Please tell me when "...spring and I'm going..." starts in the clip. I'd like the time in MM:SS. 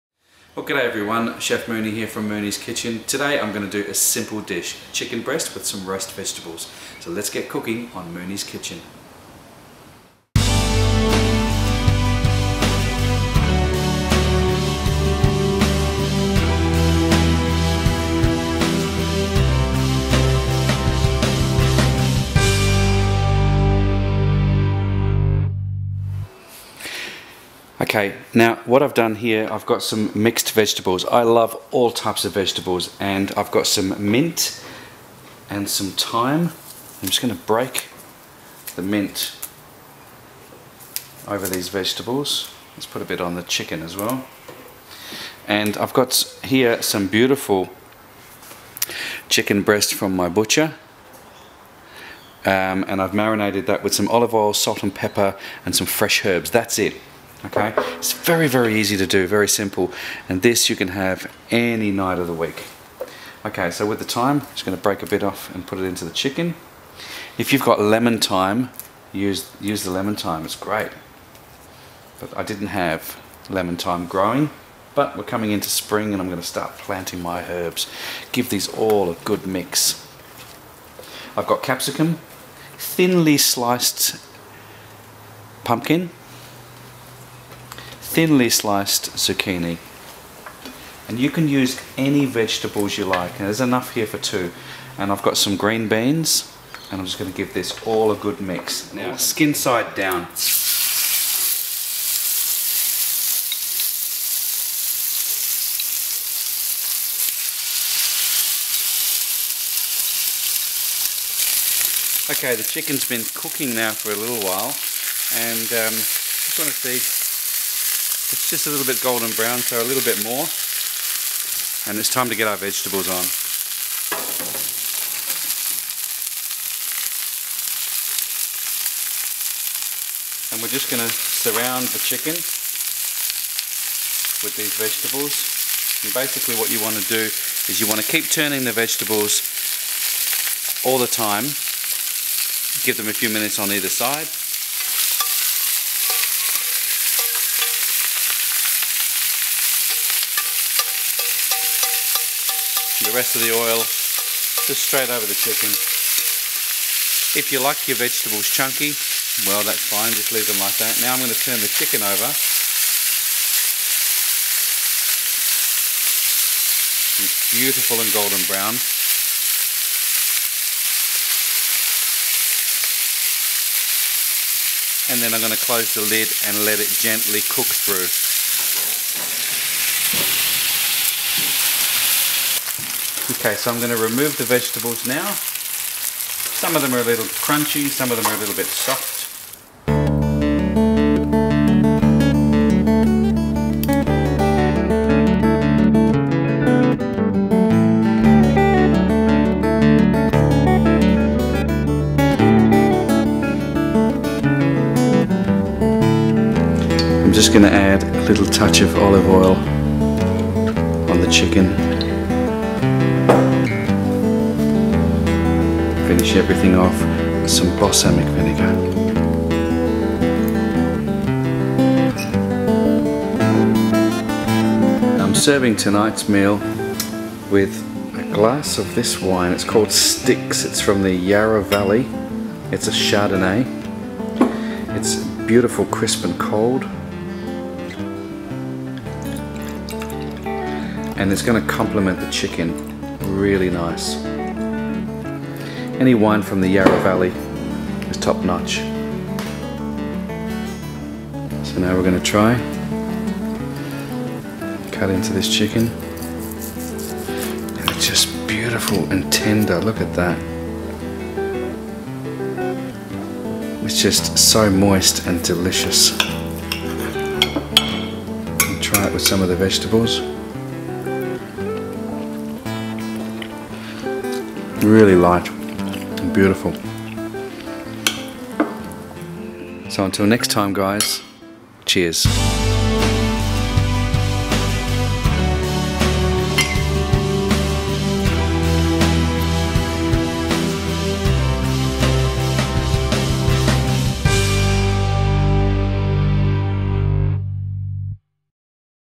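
01:15.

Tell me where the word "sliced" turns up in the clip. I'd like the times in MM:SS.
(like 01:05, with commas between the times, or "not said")
01:23, 01:28.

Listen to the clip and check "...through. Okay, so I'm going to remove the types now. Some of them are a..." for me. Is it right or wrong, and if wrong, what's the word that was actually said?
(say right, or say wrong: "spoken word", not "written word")
wrong: "vegetables", not "types".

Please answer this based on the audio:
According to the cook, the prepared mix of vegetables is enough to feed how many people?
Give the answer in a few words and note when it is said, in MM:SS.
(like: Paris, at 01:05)
2, at 01:34.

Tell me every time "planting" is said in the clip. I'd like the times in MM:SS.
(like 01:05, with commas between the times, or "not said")
01:16.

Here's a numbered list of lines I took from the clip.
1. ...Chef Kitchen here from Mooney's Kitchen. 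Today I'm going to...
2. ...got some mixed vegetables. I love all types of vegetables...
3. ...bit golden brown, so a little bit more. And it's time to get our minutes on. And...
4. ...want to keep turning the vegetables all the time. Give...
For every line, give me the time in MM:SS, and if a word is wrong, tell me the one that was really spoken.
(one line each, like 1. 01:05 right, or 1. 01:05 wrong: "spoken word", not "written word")
1. 00:01 wrong: "Mooney", not "Kitchen"
2. 00:29 right
3. 01:58 wrong: "vegetables", not "minutes"
4. 02:17 right.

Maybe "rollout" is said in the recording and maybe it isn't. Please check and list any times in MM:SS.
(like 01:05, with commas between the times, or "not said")
not said.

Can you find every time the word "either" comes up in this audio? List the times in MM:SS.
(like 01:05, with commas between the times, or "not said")
02:23.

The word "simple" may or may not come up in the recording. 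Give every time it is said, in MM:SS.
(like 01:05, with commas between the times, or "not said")
00:03, 00:59.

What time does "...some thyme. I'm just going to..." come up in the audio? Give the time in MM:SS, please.
00:35.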